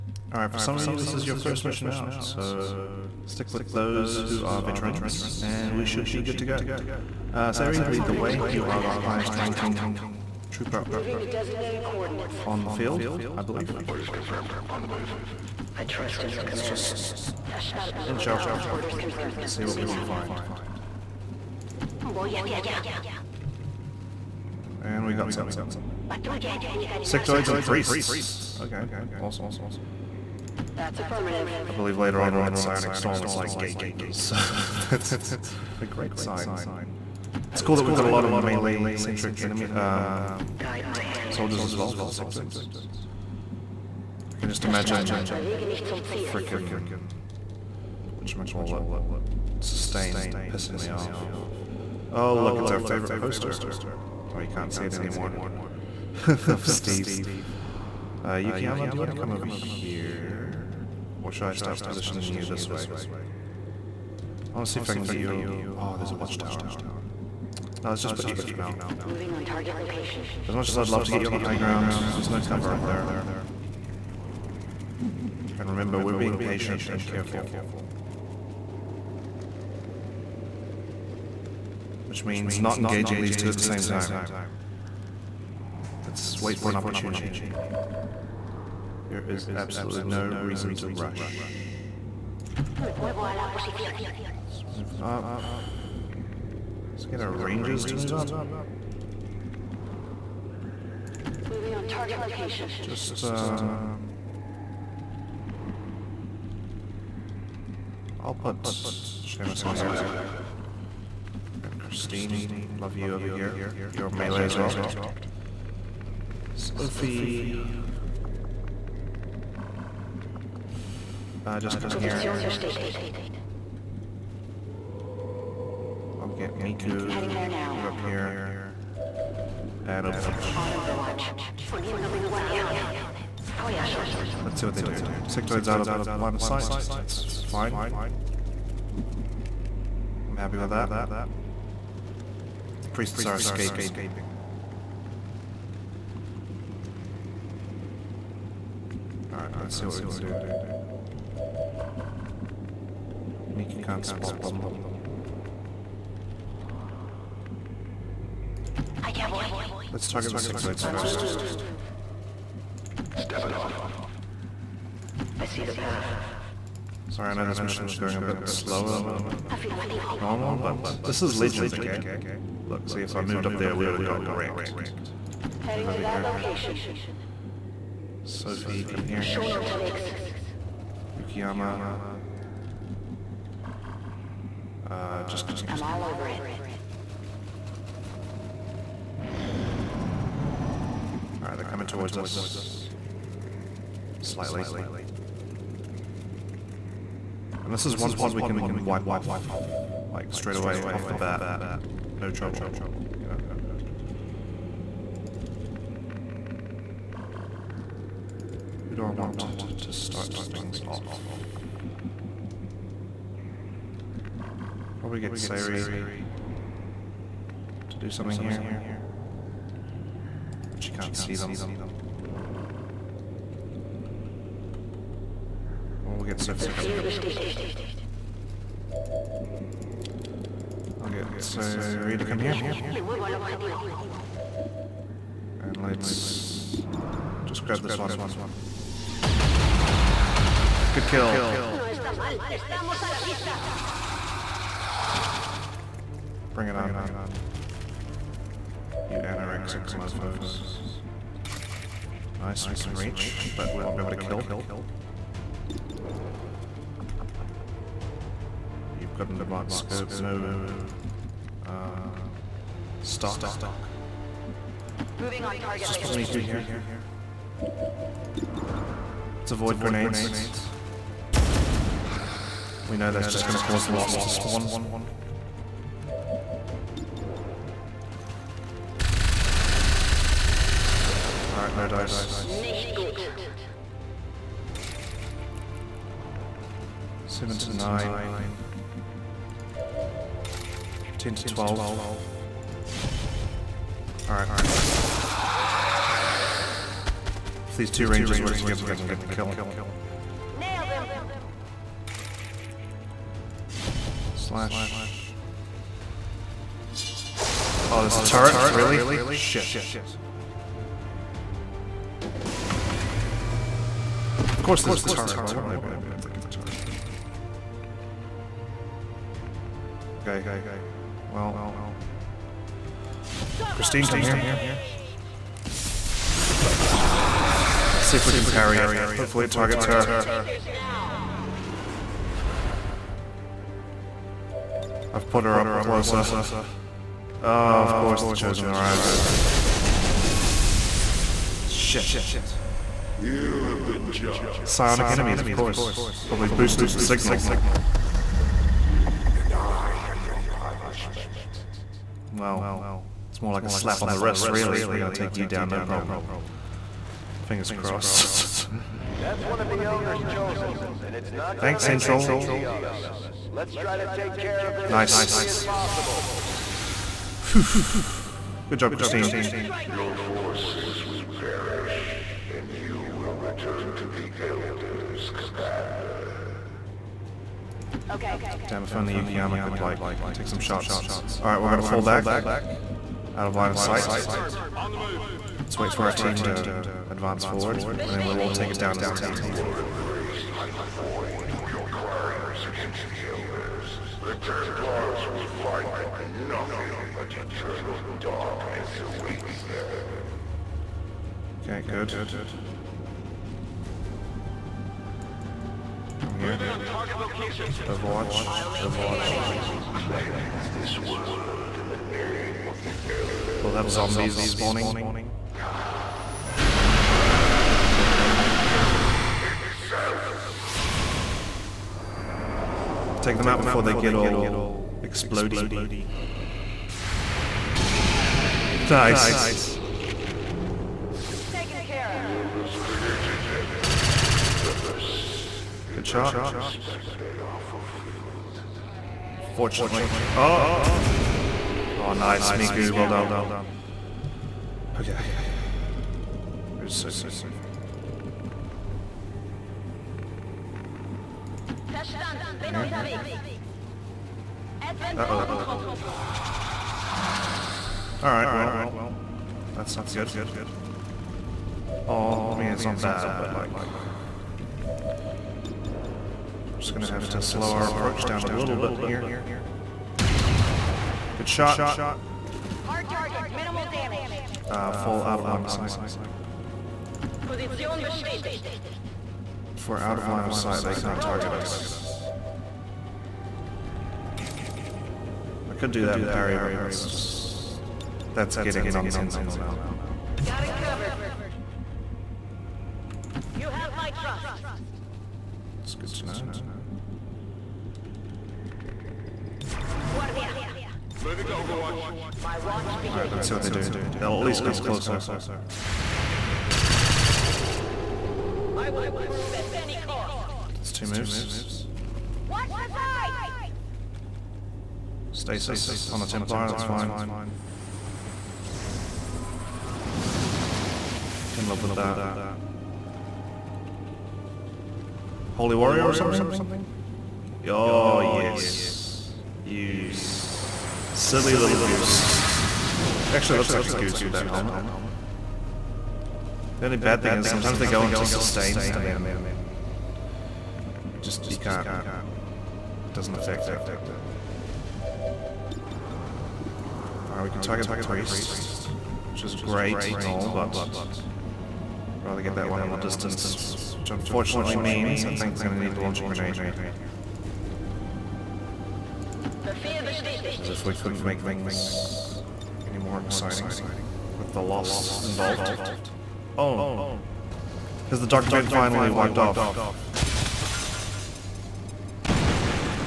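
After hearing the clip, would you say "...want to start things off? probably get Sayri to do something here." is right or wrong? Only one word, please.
right.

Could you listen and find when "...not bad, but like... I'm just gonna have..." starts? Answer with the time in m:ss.
7:42.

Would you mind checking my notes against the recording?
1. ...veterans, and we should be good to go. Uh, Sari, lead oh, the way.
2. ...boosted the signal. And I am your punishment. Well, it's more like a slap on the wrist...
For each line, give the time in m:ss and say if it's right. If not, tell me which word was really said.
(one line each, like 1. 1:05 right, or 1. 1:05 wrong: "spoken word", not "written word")
1. 0:04 right
2. 5:46 right.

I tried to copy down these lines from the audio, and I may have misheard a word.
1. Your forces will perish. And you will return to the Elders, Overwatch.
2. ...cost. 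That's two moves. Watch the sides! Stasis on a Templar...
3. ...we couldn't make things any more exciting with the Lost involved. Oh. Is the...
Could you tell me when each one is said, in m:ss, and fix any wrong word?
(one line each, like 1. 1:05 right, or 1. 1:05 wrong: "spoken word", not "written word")
1. 6:09 wrong: "Commander", not "Overwatch"
2. 8:29 right
3. 9:20 right.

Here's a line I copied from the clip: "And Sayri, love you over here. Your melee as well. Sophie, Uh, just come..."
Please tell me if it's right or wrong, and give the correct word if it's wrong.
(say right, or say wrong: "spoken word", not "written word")
wrong: "Christine", not "Sayri".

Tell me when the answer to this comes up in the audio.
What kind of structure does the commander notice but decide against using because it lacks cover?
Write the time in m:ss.
1:06.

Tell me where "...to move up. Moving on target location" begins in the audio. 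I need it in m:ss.
1:37.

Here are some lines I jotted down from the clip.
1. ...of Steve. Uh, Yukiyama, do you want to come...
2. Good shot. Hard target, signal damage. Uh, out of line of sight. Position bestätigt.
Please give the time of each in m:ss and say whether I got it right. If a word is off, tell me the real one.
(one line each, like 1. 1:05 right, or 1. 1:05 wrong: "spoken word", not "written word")
1. 0:56 right
2. 7:51 wrong: "minimal", not "signal".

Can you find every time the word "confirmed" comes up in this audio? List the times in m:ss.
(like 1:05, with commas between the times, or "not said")
0:14, 0:18.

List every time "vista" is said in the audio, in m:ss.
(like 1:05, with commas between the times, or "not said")
4:03.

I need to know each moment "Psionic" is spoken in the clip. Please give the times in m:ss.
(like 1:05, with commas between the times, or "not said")
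0:32, 5:44.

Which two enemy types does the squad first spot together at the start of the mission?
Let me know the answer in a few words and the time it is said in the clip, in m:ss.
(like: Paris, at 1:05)
Sectoids and priests, at 0:26.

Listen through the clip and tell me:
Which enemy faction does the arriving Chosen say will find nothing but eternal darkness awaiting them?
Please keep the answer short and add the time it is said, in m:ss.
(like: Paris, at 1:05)
The Templars, at 6:34.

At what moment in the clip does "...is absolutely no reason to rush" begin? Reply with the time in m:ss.
1:29.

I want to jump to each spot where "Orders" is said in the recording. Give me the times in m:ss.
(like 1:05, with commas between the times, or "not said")
0:13, 0:18.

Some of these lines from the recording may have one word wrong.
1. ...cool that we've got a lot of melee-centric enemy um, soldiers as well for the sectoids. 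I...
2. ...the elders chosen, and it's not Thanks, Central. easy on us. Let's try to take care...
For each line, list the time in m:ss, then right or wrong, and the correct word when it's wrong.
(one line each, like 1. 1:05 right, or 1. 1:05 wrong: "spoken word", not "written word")
1. 0:37 right
2. 5:59 right.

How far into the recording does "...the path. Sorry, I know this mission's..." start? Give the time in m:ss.
2:45.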